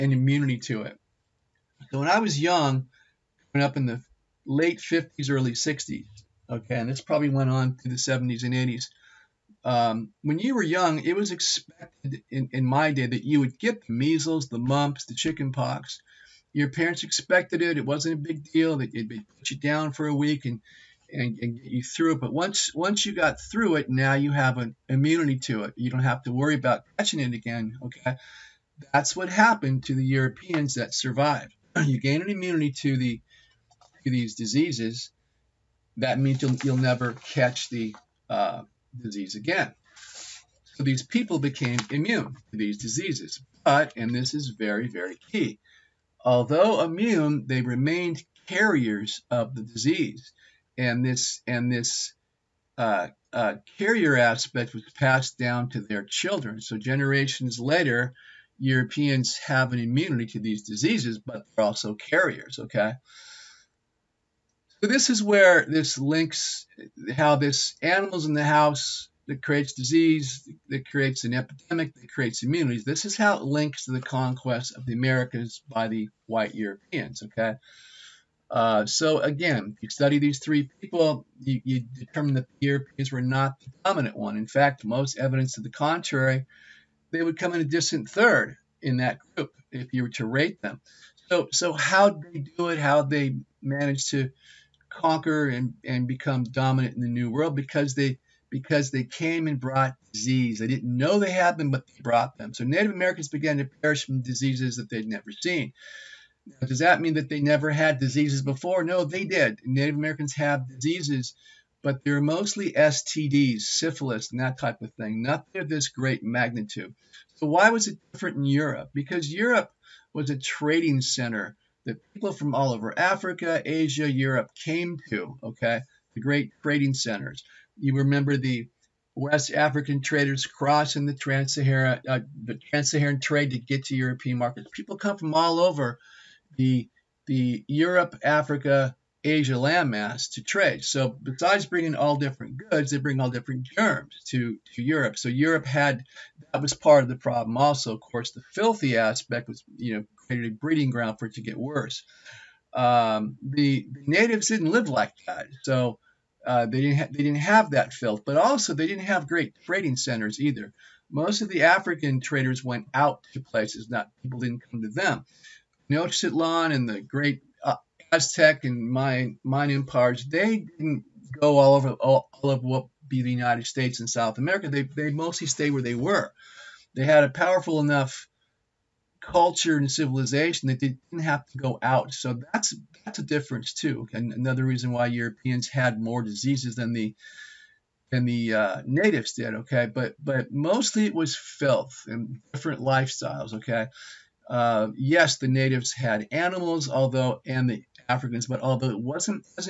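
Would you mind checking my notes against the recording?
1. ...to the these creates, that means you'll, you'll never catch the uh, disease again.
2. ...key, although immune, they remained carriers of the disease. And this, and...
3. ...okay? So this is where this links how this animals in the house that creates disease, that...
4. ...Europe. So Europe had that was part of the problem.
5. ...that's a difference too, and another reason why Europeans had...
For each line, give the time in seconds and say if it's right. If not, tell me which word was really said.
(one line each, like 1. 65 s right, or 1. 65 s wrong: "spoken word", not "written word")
1. 32 s wrong: "diseases", not "creates"
2. 45 s right
3. 62 s right
4. 144 s right
5. 183 s right.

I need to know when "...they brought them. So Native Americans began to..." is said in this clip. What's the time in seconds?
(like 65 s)
101 s.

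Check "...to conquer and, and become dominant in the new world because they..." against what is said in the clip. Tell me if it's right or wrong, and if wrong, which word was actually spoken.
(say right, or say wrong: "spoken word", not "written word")
right.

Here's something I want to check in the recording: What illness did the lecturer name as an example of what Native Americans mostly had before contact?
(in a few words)
Syphilis.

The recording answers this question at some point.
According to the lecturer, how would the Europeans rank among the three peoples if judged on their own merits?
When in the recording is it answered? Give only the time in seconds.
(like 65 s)
87 s.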